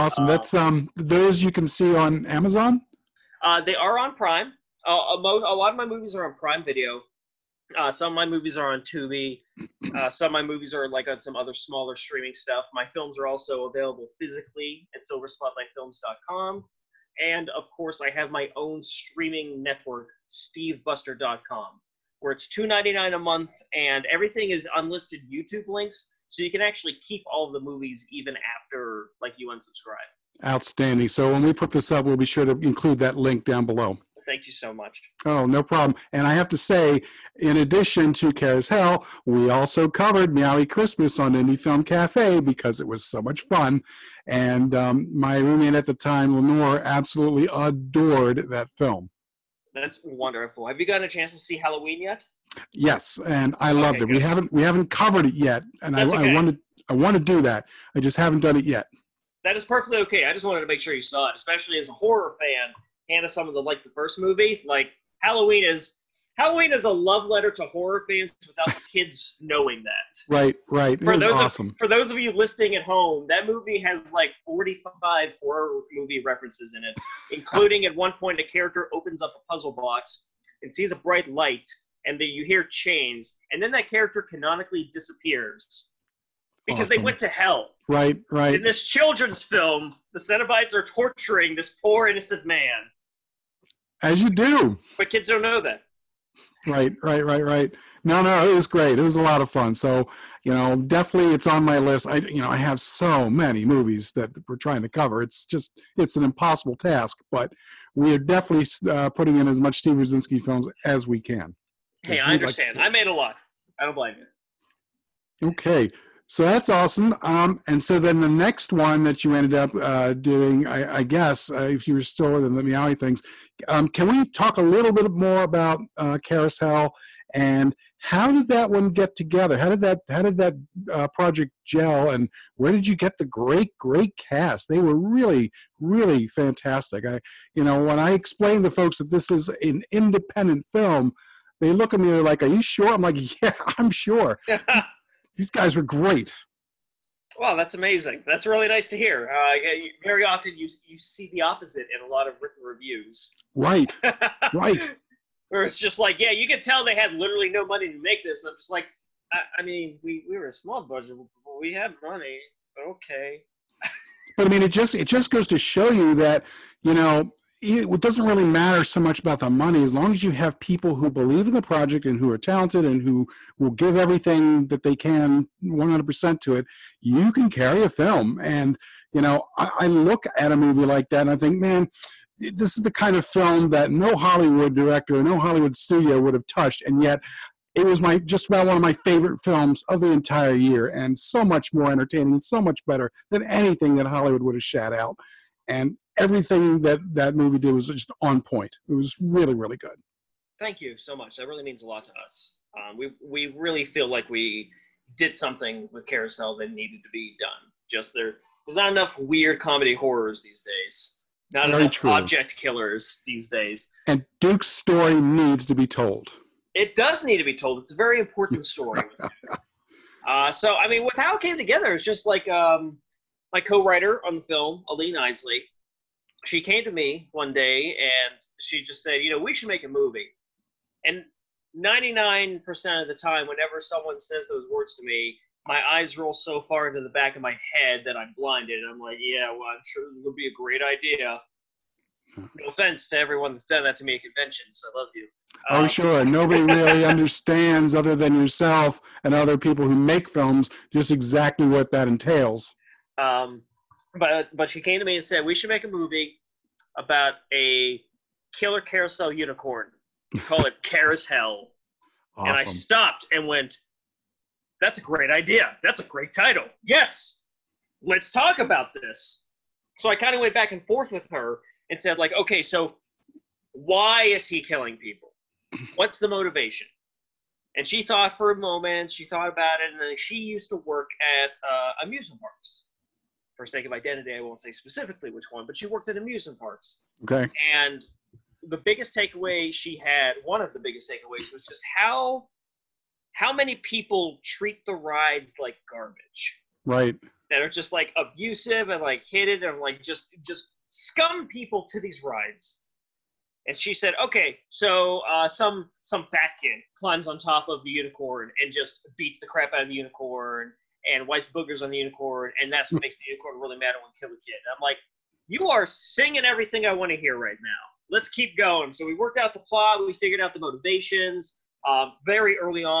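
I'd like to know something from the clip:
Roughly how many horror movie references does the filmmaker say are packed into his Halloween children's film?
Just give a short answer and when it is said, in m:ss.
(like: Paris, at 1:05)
45, at 1:14.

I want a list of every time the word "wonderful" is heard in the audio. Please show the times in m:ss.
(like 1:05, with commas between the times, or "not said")
0:50.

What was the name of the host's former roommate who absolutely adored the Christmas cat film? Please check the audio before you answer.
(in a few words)
Lenore.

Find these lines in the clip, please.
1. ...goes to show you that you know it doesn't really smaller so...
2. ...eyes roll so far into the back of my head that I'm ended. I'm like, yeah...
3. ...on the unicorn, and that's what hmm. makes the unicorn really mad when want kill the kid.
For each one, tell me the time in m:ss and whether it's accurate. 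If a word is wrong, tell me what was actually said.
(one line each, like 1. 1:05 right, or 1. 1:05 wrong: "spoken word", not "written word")
1. 2:45 wrong: "matter", not "smaller"
2. 3:55 wrong: "blinded", not "ended"
3. 5:11 right.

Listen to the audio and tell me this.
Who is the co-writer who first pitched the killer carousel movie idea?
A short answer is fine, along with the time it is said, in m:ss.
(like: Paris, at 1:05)
Aline Isley, at 3:44.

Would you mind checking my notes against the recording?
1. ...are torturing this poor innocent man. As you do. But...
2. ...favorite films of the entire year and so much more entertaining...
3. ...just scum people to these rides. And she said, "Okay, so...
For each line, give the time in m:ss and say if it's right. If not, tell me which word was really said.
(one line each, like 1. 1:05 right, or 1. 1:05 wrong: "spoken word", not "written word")
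1. 1:30 right
2. 3:08 right
3. 5:00 right.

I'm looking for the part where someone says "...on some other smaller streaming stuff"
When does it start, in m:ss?
0:11.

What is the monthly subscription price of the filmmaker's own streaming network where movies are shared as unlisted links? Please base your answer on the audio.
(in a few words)
$2.99.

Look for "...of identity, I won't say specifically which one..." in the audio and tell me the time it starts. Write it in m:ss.
4:43.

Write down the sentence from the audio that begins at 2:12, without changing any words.
And where did you get the great great cast?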